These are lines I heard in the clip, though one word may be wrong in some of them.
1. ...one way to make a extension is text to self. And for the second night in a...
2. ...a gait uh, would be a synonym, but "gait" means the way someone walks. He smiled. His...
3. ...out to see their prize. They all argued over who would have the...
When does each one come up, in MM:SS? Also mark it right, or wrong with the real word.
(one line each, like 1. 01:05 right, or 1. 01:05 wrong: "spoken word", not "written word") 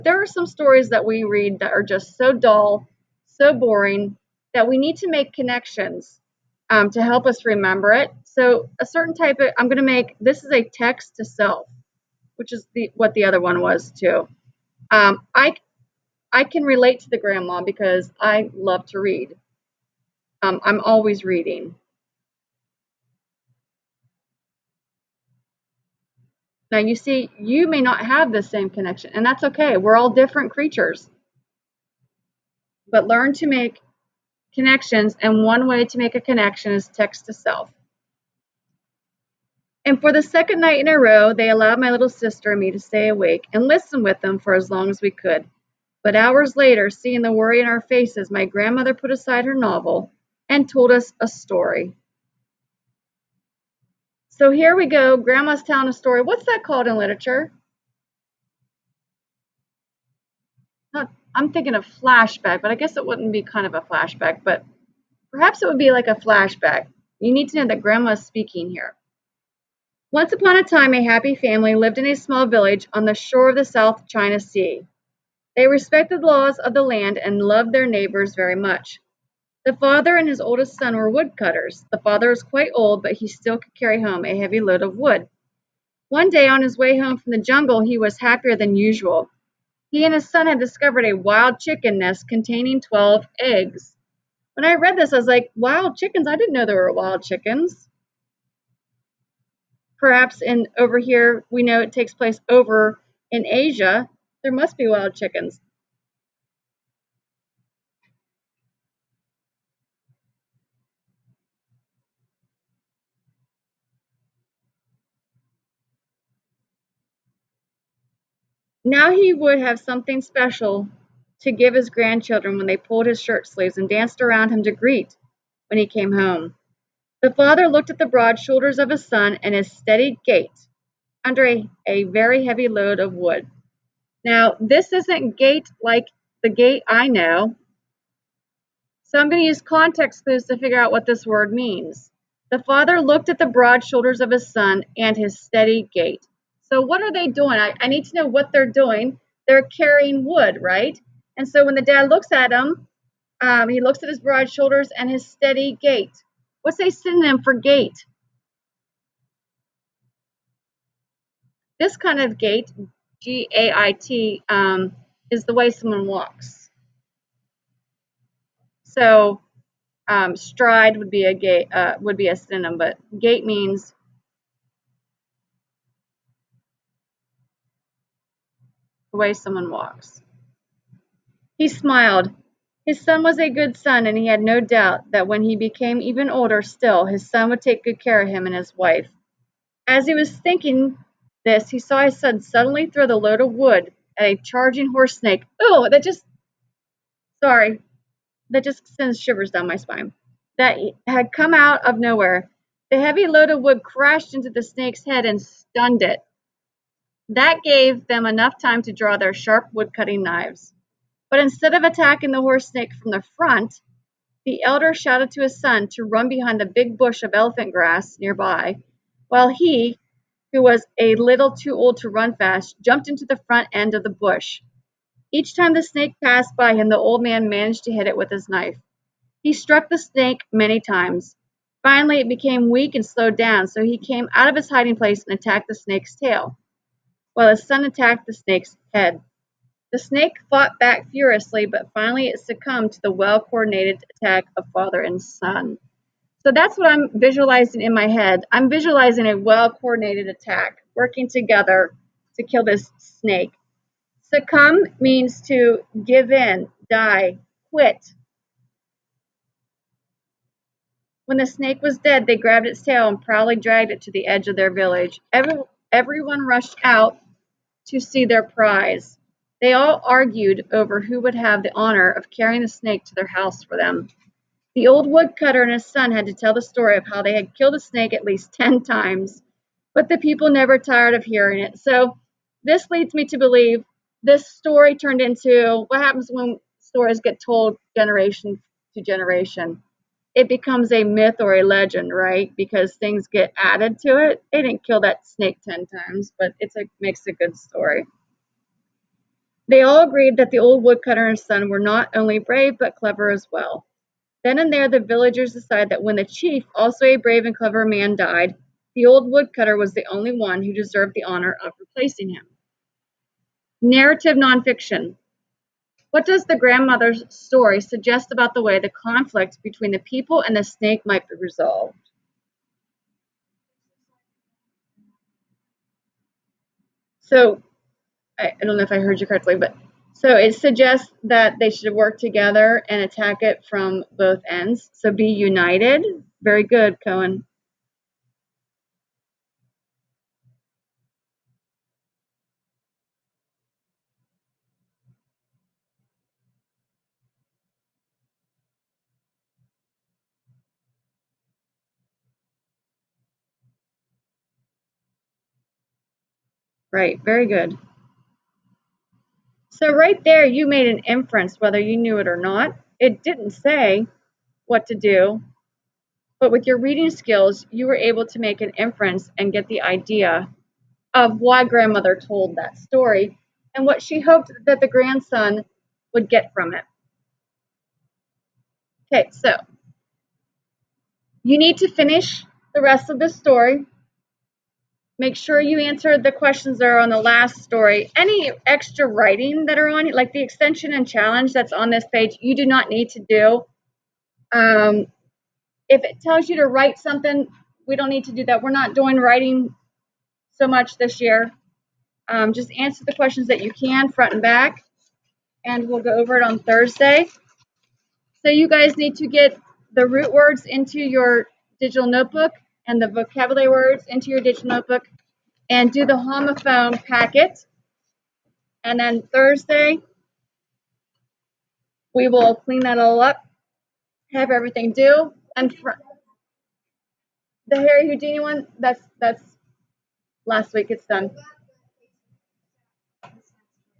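1. 00:35 wrong: "connection", not "extension"
2. 02:51 right
3. 04:26 right.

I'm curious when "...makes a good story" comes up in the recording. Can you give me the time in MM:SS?
04:56.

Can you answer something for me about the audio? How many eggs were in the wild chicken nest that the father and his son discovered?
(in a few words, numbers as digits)
12.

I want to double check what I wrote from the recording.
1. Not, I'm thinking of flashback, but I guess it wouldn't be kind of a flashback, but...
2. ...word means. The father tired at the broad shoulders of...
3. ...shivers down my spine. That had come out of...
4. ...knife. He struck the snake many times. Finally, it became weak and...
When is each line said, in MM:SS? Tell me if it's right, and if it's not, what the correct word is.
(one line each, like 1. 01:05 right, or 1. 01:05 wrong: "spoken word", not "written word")
1. 01:00 right
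2. 02:21 wrong: "looked", not "tired"
3. 03:19 right
4. 03:48 right.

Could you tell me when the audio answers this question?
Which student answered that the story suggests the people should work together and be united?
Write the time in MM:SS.
05:37.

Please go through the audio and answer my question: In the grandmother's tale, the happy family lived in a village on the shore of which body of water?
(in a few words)
South China Sea.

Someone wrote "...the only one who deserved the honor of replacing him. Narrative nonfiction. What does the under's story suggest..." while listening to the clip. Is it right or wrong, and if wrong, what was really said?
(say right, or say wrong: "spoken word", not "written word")
wrong: "grandmother", not "under".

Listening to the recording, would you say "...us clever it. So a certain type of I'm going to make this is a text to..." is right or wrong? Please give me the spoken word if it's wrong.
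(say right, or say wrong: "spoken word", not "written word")
wrong: "remember", not "clever".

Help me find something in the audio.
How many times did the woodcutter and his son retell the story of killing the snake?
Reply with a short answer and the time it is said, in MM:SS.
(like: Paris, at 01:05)
10, at 04:38.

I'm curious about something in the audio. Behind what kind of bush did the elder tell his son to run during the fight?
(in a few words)
elephant grass.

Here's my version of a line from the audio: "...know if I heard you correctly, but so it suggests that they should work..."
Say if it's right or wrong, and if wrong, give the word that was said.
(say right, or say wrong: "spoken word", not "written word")
right.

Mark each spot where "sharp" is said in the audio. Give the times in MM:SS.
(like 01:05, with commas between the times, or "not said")
03:29.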